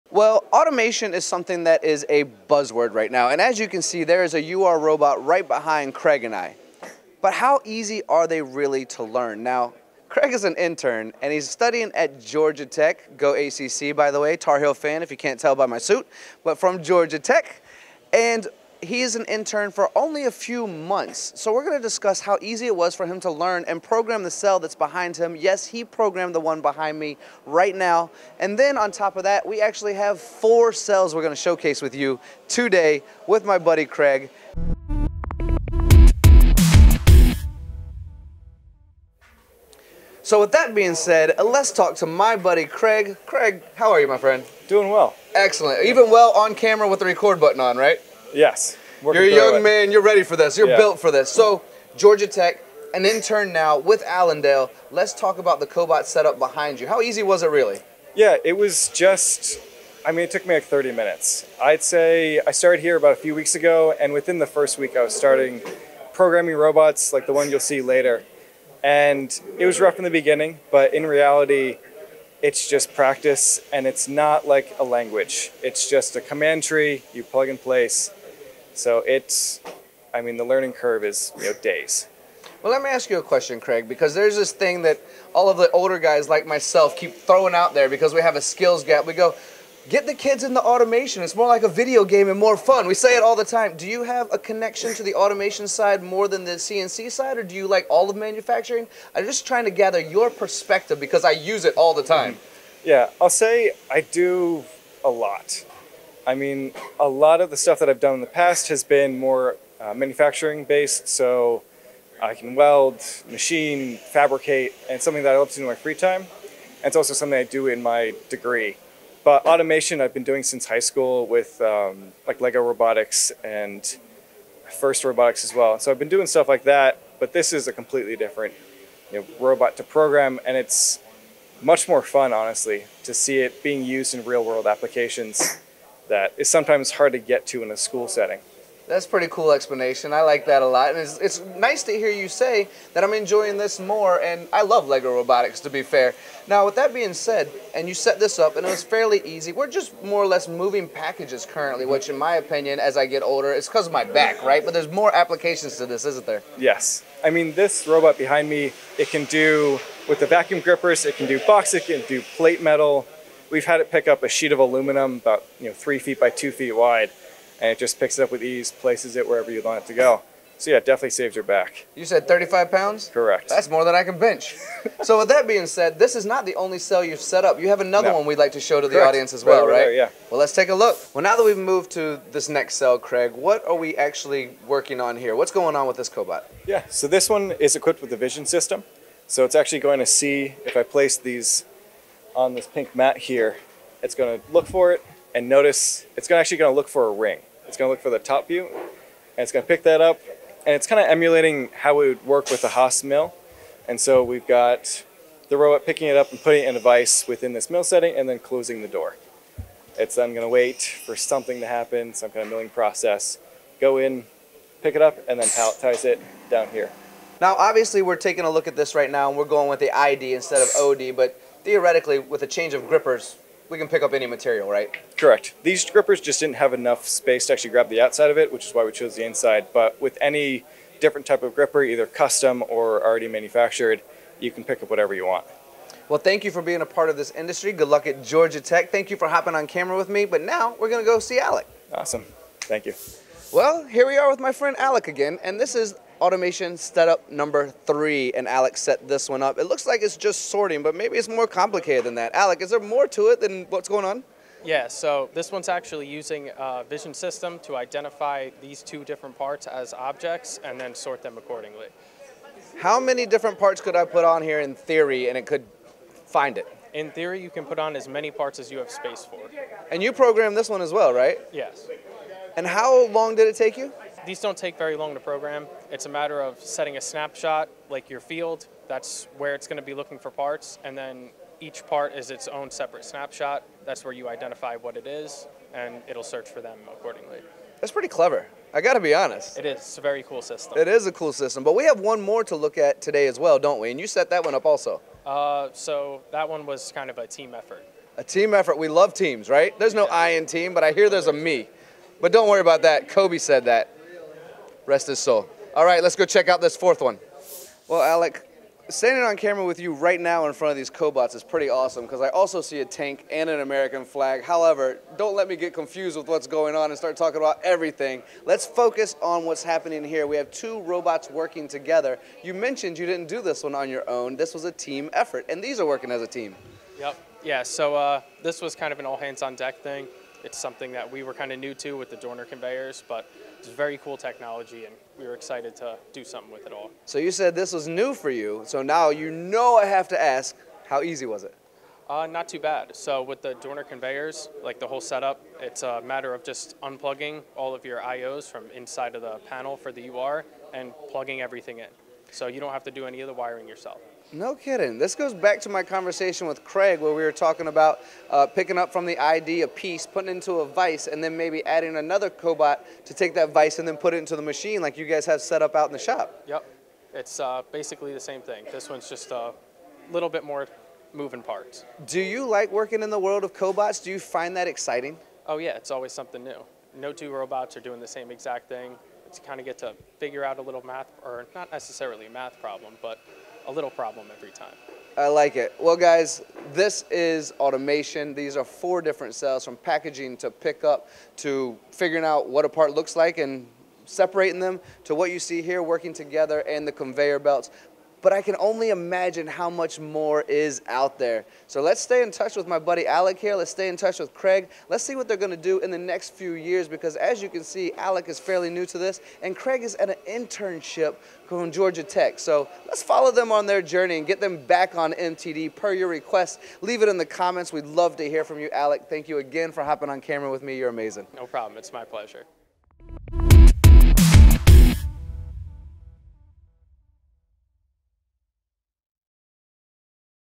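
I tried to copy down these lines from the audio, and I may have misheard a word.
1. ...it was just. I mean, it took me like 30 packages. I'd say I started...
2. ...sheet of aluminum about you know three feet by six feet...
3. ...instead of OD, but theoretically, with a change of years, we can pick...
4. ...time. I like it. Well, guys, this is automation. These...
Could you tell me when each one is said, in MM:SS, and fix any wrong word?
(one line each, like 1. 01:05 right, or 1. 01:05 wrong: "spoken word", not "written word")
1. 00:58 wrong: "minutes", not "packages"
2. 02:44 wrong: "two", not "six"
3. 03:40 wrong: "grippers", not "years"
4. 06:24 right.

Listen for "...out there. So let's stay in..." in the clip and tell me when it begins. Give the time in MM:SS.
06:40.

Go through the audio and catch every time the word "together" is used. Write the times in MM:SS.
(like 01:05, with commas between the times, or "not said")
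05:21, 06:36.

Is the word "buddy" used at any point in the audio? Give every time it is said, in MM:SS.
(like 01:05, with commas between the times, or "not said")
00:33, 00:42, 06:42.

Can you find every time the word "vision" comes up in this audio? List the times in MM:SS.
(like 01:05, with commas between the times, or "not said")
03:08, 04:16.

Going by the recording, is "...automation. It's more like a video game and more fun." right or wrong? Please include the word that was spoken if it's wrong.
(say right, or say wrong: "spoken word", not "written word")
right.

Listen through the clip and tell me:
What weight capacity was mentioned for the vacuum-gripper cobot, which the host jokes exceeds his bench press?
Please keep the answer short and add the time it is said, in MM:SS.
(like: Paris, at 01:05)
35 pounds, at 02:52.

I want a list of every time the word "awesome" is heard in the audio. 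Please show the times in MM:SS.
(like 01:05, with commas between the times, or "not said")
04:01, 05:11.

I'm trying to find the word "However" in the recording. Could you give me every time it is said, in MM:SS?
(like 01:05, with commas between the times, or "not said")
05:14.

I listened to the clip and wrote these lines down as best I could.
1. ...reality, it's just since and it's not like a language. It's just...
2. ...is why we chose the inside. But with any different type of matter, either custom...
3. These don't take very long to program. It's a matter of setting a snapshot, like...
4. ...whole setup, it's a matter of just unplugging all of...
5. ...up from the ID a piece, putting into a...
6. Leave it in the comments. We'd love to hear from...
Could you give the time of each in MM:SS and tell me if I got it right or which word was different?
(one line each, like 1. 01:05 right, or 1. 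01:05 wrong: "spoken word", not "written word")
1. 01:11 wrong: "practice", not "since"
2. 03:48 wrong: "gripper", not "matter"
3. 04:34 right
4. 05:44 right
5. 05:58 right
6. 06:56 right.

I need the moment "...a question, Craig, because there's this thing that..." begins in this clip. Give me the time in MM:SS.
01:23.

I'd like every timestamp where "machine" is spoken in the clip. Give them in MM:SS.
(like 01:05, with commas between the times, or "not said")
01:53, 06:04.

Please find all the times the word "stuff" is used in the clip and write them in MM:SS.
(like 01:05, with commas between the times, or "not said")
01:47, 02:06.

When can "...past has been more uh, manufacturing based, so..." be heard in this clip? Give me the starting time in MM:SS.
01:48.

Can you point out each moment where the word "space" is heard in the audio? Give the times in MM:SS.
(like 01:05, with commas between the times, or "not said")
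03:47, 04:28.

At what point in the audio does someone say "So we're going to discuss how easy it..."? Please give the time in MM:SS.
00:21.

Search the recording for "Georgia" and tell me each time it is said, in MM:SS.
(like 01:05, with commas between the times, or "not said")
00:12, 00:16, 00:51, 03:58, 06:51.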